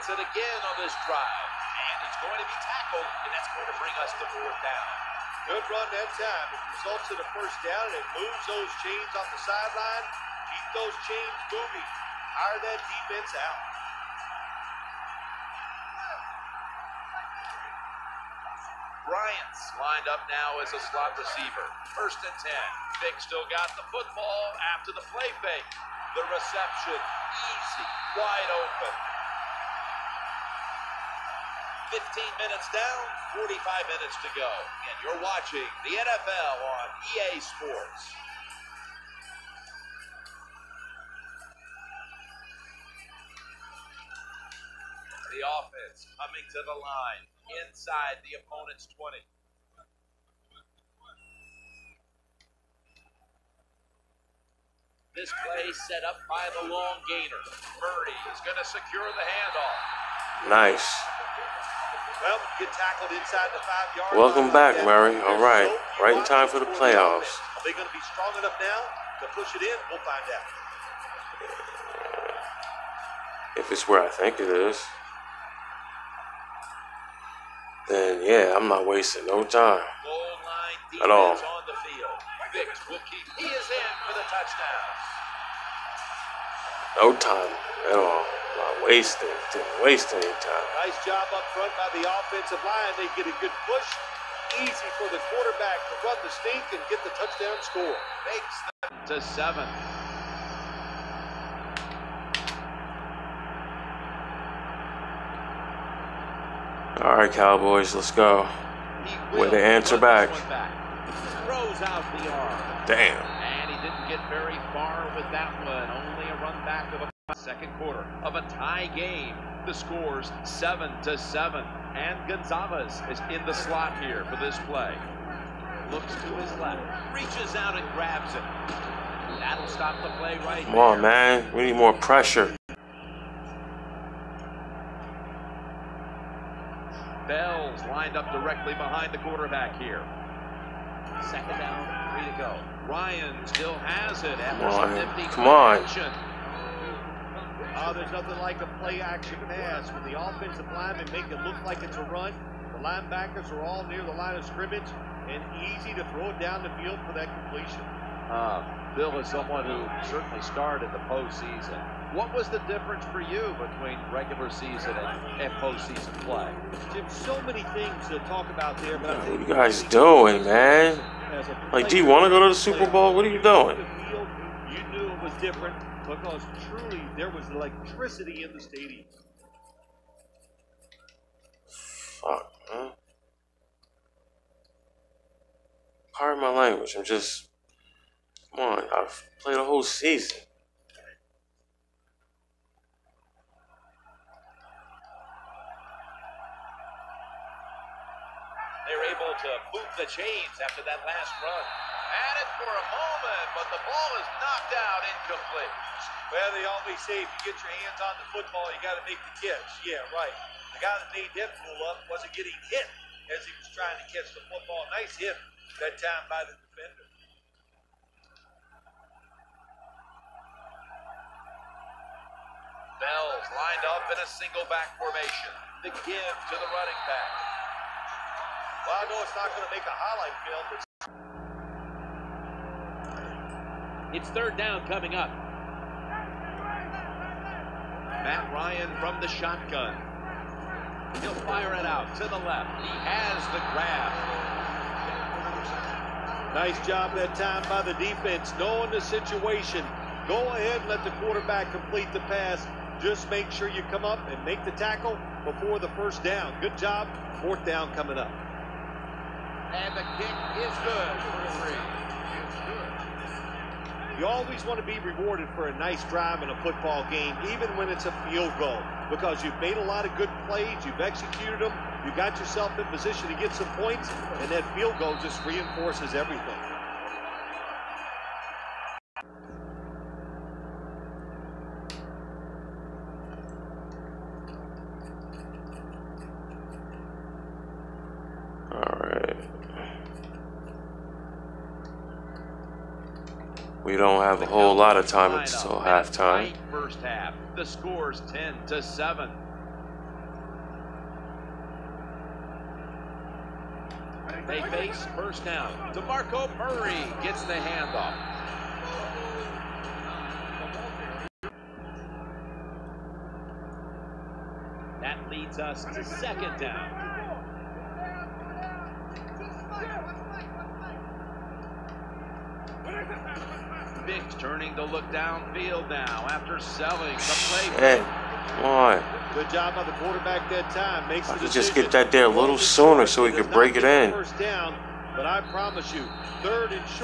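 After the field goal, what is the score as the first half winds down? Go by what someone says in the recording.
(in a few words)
10 to 7.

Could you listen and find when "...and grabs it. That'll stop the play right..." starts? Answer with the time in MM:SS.
02:07.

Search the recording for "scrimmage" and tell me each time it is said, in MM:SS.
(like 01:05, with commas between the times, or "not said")
02:34.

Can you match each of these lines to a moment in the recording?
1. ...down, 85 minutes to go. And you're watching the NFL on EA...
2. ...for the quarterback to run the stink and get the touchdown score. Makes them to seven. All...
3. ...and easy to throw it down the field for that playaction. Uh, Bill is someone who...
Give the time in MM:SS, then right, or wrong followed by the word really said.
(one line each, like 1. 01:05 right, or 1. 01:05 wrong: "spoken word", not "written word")
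1. 00:32 wrong: "45", not "85"
2. 01:34 right
3. 02:35 wrong: "completion", not "playaction".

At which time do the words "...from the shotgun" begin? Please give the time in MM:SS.
03:58.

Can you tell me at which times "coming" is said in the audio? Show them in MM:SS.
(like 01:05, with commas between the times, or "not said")
00:46, 03:54, 04:17.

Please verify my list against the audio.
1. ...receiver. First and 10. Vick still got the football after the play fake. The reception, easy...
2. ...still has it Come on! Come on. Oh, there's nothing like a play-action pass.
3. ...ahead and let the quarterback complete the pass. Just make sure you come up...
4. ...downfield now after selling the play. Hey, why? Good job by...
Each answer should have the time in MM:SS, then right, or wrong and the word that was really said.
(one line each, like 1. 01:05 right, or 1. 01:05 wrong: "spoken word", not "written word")
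1. 00:21 right
2. 02:23 right
3. 04:10 right
4. 05:25 right.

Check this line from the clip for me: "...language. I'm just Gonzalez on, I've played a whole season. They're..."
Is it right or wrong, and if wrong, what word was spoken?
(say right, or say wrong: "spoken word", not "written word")
wrong: "Come", not "Gonzalez".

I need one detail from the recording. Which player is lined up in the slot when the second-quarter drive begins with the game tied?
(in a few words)
Gonzalez.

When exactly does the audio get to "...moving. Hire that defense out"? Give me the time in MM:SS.
00:11.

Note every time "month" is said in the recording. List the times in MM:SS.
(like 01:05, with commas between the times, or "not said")
not said.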